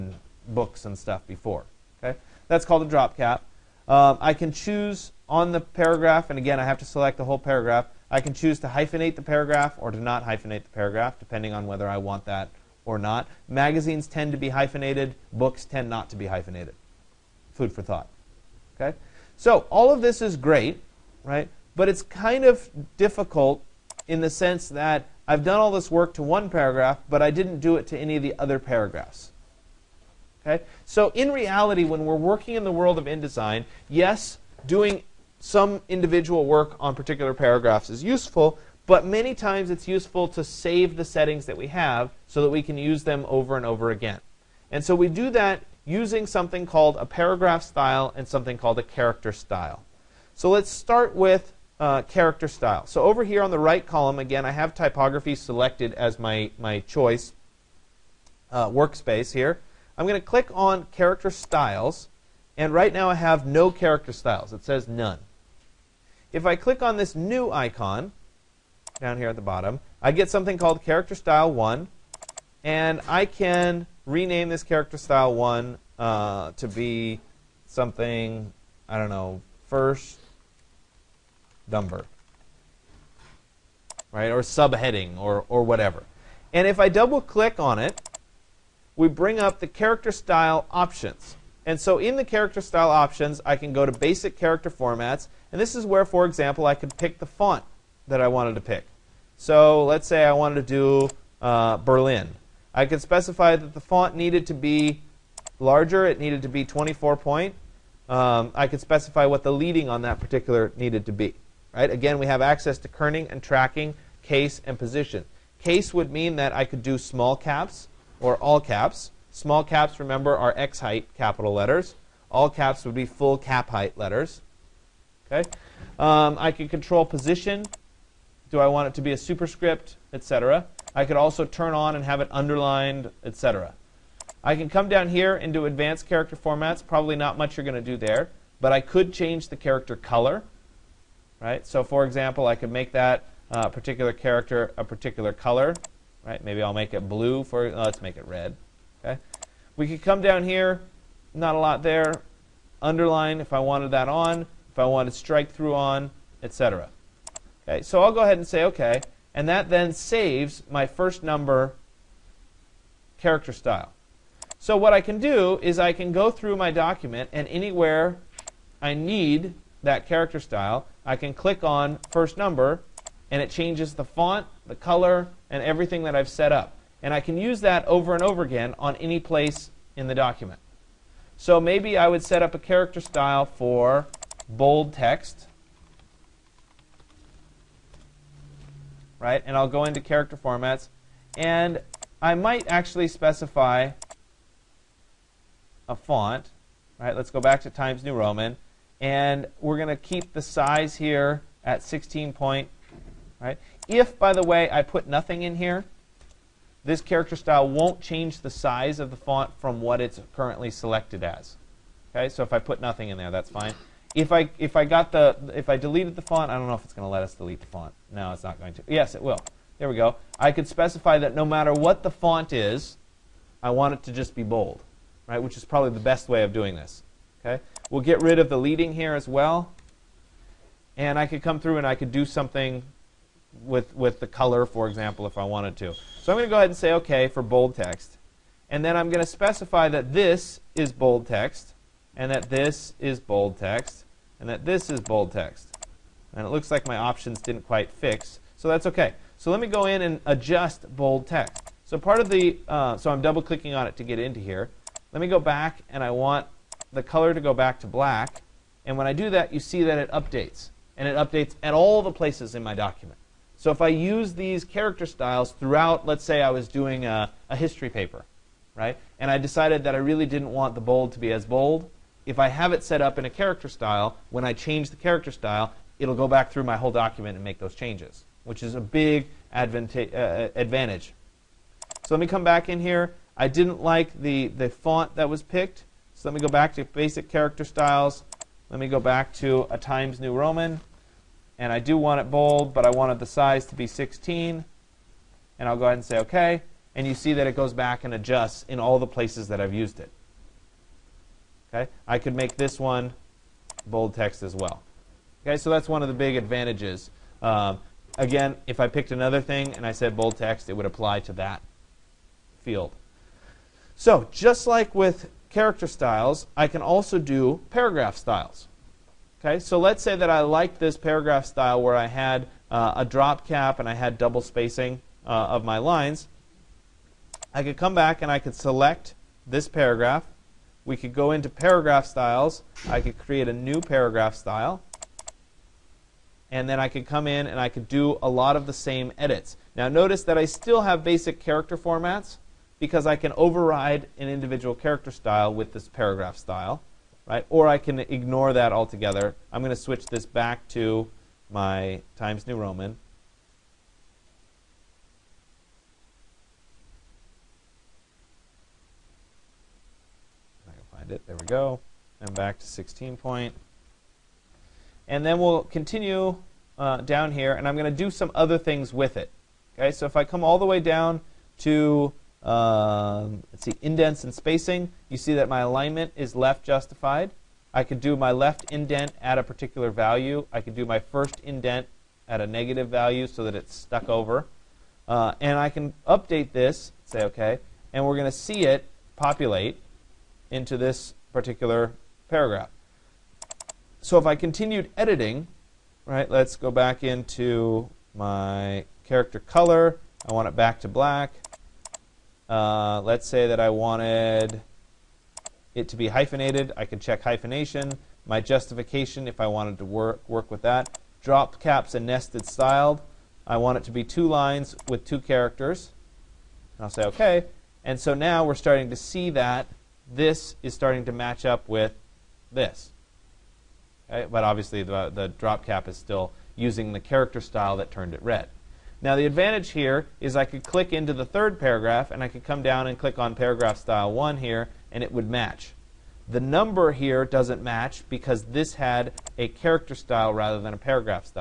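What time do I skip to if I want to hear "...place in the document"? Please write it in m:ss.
2:59.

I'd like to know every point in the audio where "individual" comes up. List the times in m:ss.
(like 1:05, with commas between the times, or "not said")
0:35, 5:44.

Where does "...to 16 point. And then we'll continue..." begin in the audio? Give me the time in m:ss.
6:02.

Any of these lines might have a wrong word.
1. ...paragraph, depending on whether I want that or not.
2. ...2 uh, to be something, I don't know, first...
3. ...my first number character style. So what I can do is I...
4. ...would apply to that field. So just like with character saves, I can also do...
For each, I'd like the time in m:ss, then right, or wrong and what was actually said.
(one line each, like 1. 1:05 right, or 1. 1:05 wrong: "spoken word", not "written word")
1. 0:10 right
2. 1:15 wrong: "1", not "2"
3. 2:40 right
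4. 5:10 wrong: "styles", not "saves".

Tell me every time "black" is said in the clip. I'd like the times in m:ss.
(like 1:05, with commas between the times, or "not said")
4:17, 6:40.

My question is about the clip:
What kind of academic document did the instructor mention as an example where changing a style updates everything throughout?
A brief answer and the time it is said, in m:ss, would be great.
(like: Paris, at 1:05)
History paper, at 4:27.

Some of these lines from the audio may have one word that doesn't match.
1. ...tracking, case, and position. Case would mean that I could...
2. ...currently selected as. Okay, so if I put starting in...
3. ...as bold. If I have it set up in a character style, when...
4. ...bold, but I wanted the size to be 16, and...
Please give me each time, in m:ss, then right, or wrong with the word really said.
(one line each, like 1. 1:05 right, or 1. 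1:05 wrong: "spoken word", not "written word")
1. 1:53 right
2. 3:30 wrong: "nothing", not "starting"
3. 4:31 right
4. 4:52 right.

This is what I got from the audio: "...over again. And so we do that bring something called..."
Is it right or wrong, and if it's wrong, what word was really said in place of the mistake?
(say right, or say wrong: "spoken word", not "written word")
wrong: "using", not "bring".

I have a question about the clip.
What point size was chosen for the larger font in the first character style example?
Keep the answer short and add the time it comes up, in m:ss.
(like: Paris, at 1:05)
24 point, at 1:46.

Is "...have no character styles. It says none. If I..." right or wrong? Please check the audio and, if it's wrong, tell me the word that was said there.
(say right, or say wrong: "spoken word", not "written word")
right.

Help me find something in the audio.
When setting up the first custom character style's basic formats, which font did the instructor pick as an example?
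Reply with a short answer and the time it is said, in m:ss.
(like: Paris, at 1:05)
Berlin, at 1:41.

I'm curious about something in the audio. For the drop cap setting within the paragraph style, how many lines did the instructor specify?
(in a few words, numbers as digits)
2.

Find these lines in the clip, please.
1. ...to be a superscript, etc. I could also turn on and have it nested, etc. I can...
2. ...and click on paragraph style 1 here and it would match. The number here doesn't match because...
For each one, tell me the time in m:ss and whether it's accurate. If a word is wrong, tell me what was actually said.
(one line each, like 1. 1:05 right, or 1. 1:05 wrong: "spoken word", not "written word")
1. 2:08 wrong: "underlined", not "nested"
2. 7:12 right.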